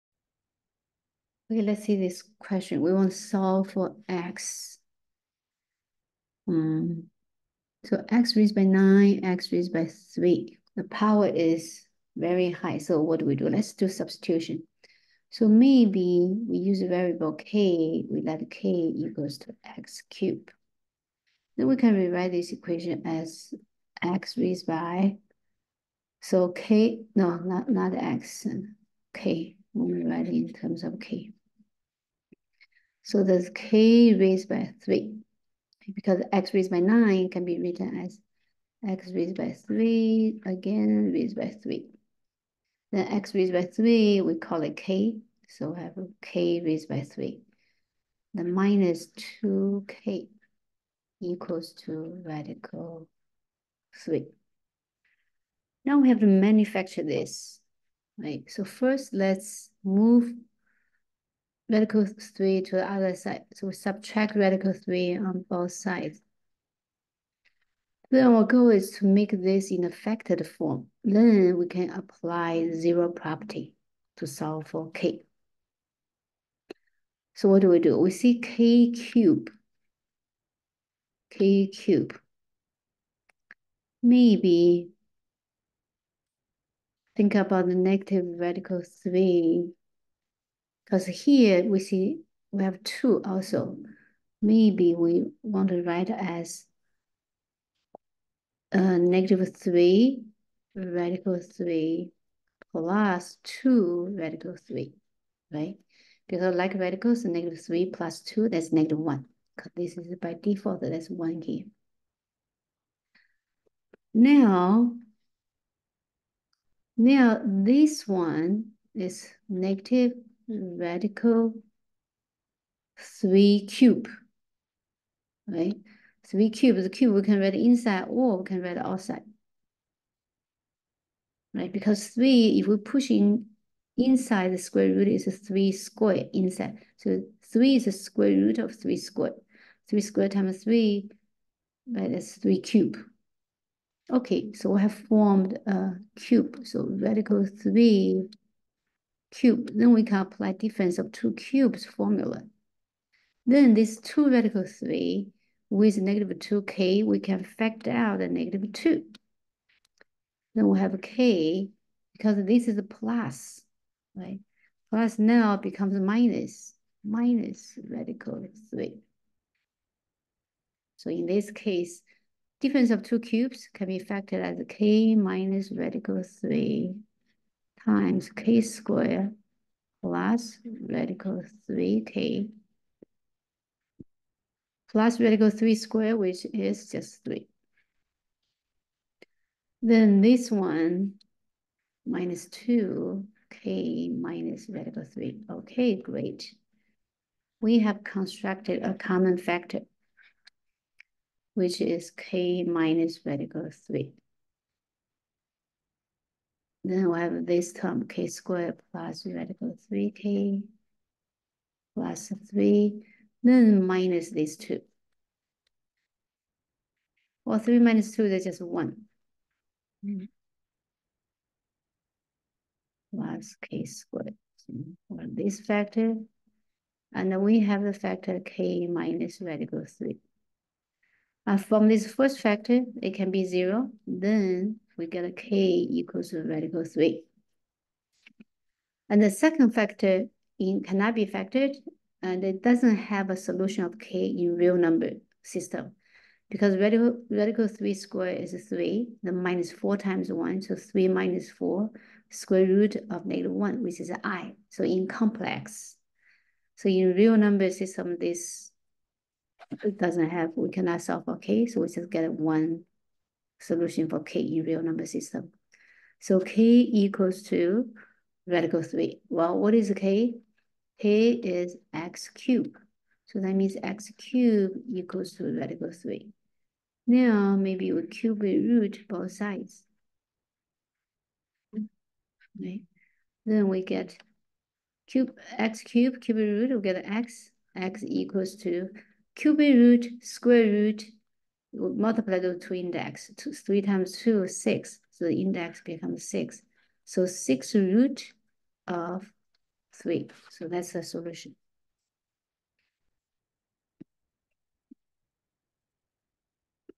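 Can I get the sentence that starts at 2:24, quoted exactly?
Okay, so we have formed a cube.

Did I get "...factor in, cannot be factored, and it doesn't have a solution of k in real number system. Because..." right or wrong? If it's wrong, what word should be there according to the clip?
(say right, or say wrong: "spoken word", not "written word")
right.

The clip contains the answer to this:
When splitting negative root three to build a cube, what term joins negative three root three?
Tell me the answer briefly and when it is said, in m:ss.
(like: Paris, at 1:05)
2 radical 3, at 1:42.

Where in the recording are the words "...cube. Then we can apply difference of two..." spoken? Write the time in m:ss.
2:29.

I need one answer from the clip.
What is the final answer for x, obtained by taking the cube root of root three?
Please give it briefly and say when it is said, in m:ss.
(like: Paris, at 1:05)
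sixth root of 3, at 4:57.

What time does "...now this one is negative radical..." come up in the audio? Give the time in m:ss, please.
1:56.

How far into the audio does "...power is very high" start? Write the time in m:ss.
0:10.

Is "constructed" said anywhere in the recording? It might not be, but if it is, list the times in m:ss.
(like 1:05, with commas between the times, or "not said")
3:18.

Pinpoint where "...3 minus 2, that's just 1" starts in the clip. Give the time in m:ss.
3:37.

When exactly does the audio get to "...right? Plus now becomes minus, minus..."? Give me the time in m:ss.
2:44.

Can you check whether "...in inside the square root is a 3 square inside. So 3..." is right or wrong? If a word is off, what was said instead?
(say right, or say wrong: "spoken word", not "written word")
right.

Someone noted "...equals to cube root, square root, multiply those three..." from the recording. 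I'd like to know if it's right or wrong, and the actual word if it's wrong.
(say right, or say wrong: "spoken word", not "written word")
wrong: "two", not "three".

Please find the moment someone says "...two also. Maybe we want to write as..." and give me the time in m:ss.
1:32.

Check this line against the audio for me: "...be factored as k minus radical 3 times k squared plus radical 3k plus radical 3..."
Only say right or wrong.
right.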